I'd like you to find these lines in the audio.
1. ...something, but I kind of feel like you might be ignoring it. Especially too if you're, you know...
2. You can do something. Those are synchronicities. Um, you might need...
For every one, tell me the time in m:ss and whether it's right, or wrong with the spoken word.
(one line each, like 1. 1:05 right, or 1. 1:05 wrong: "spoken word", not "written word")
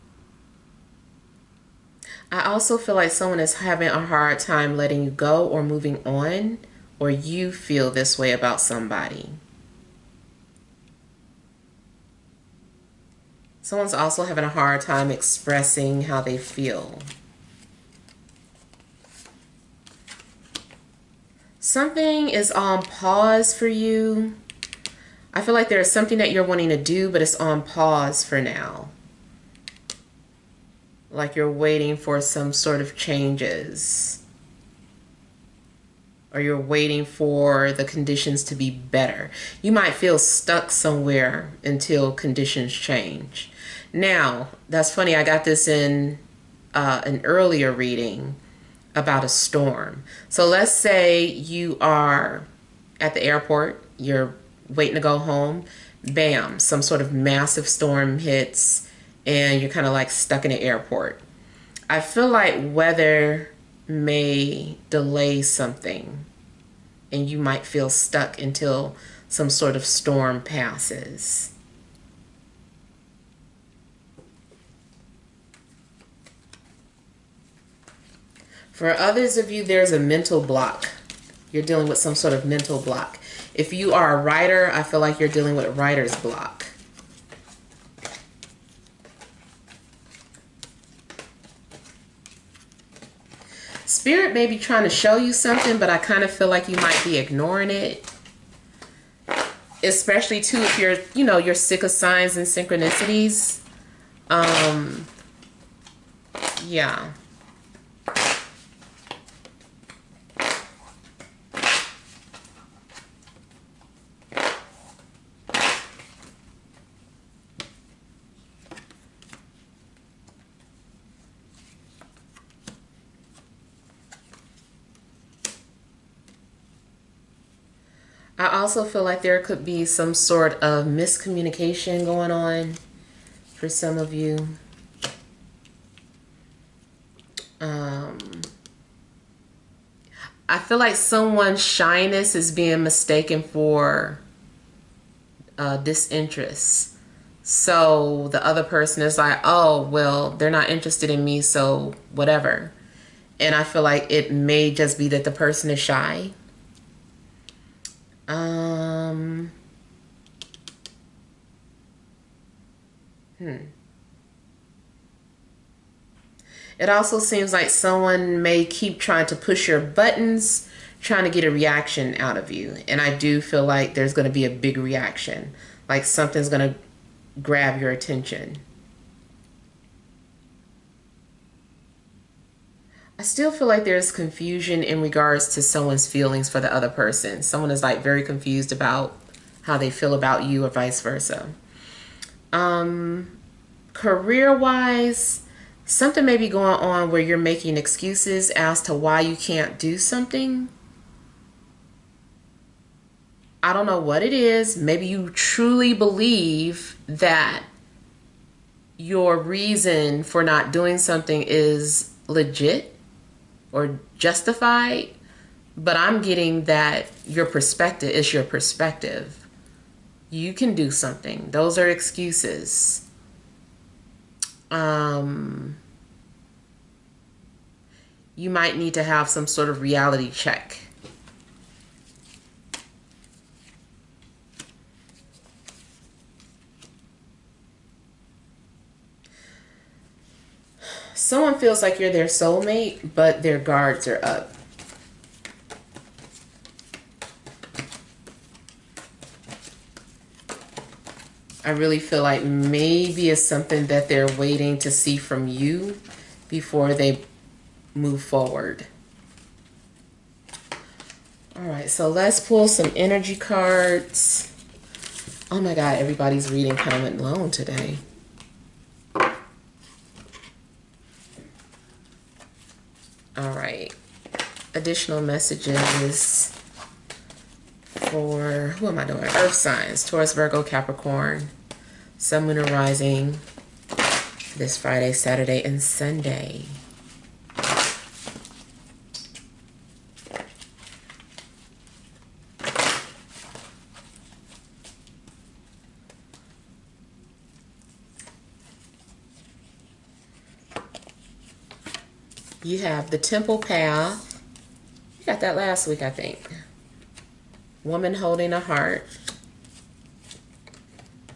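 1. 1:35 right
2. 3:40 wrong: "excuses", not "synchronicities".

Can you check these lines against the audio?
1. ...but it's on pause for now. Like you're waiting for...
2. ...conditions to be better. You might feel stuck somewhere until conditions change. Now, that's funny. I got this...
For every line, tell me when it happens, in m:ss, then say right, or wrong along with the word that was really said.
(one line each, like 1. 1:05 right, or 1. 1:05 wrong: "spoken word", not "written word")
1. 0:27 right
2. 0:37 right.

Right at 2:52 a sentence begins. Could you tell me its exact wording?
And I do feel like there's going to be a big reaction, like something's going to grab your attention.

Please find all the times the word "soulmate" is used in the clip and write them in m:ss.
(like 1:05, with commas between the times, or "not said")
4:02.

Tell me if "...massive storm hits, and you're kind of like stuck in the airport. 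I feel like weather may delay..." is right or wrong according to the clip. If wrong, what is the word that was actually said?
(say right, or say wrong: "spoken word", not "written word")
right.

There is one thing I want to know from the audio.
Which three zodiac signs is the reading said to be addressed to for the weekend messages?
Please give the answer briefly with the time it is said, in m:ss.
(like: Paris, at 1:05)
Taurus, Virgo, Capricorn, at 4:40.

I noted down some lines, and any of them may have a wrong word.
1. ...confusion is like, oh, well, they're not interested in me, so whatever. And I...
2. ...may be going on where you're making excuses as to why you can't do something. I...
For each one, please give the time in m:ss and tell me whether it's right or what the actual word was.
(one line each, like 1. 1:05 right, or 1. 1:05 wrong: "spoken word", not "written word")
1. 2:28 wrong: "person", not "confusion"
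2. 3:16 right.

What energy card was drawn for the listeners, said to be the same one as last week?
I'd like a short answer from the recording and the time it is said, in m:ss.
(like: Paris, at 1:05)
Temple Path, at 5:03.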